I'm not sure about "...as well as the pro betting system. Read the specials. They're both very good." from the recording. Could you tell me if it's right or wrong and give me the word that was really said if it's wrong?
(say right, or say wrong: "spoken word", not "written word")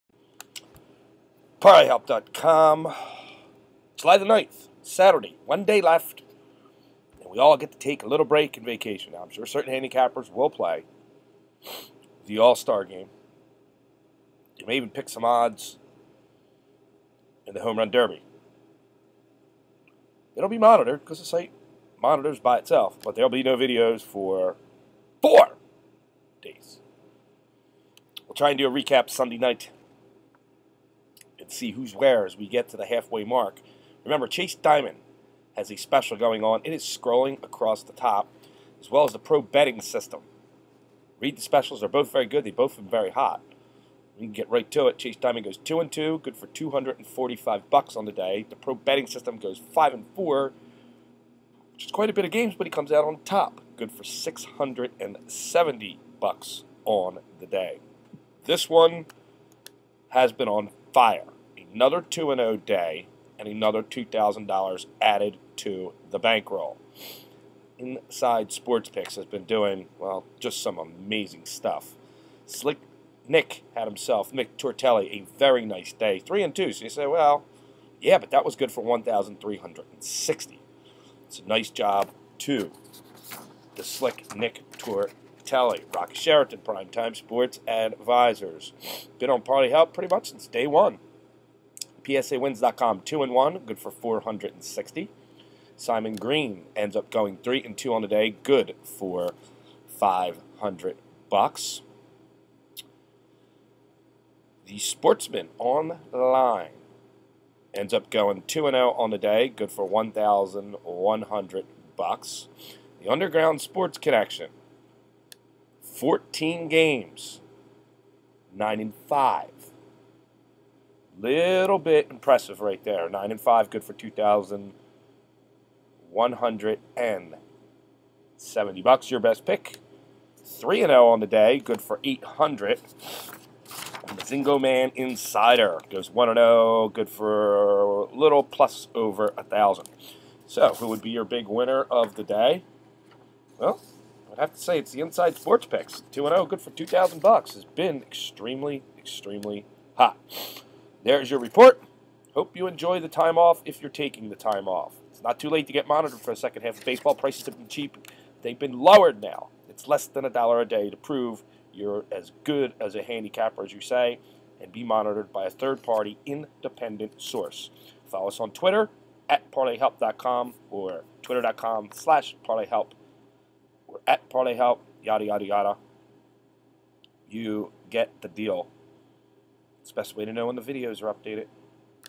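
right.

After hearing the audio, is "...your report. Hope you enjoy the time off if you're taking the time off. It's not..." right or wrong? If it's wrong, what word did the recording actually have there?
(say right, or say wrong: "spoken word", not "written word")
right.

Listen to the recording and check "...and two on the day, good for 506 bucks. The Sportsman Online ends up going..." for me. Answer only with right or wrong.
wrong.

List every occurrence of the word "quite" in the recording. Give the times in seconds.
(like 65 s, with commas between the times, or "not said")
51 s.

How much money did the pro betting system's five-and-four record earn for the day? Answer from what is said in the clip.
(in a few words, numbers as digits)
$670.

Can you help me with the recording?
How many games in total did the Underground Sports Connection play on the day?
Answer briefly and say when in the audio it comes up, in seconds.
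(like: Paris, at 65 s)
14, at 115 s.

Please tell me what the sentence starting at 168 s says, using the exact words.
Follow us on Twitter at parlayhelp.com or twitter.com slash parlayhelp or at parlayhelp, yada, yada, yada.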